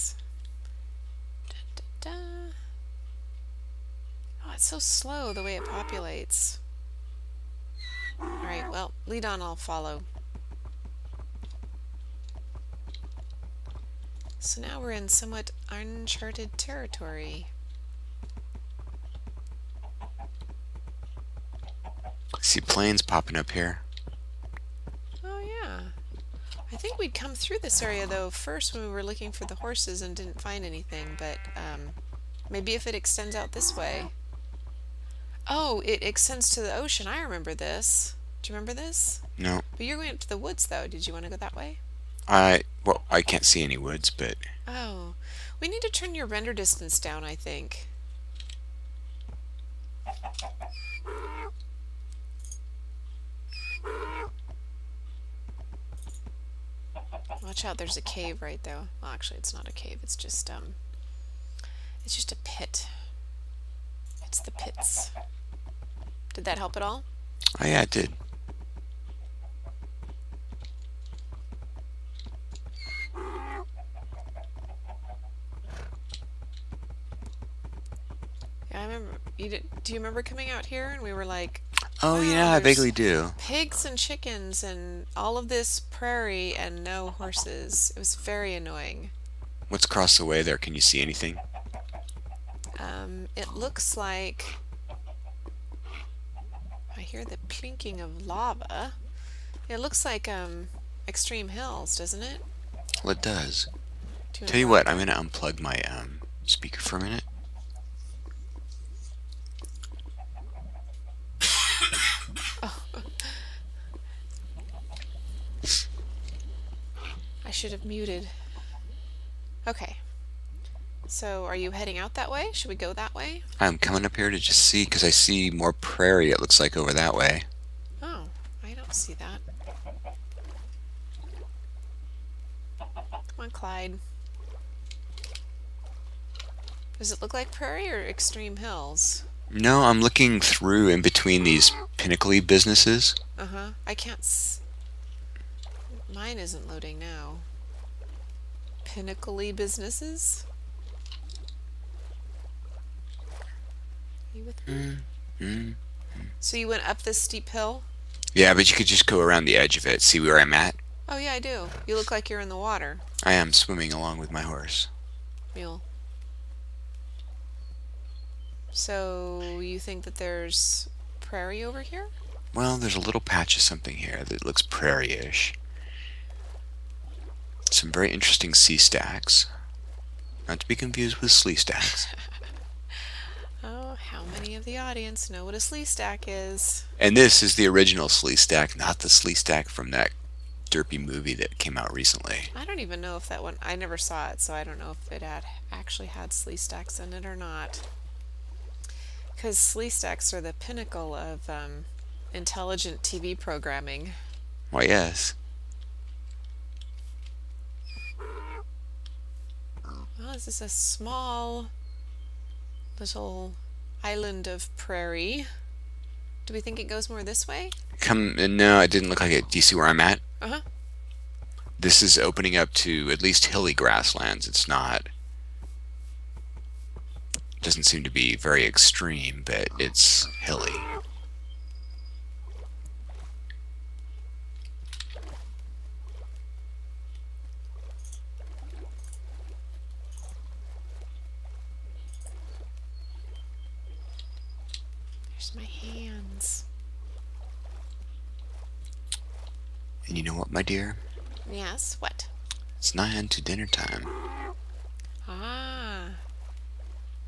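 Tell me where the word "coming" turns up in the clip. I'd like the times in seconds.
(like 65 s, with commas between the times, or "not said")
80 s, 123 s.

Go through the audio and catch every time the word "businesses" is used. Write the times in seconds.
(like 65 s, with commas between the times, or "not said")
142 s, 149 s.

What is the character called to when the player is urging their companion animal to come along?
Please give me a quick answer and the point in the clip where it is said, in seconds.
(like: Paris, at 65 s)
Clyde, at 133 s.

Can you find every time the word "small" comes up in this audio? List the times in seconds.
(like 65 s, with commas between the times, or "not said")
210 s.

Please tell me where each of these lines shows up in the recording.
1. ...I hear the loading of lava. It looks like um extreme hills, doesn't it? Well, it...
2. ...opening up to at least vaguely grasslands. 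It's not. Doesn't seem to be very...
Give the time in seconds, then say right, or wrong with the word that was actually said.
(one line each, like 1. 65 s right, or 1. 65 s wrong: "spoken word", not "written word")
1. 96 s wrong: "plinking", not "loading"
2. 222 s wrong: "hilly", not "vaguely".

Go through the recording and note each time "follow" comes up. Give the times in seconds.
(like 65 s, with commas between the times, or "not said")
9 s.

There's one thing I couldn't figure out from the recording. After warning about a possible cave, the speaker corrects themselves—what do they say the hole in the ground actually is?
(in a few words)
a pit.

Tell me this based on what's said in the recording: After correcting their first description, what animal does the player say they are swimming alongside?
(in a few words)
Mule.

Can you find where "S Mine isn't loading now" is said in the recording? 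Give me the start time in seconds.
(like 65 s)
144 s.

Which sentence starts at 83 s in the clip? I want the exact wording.
Pigs and chickens and all of this prairie and no horses.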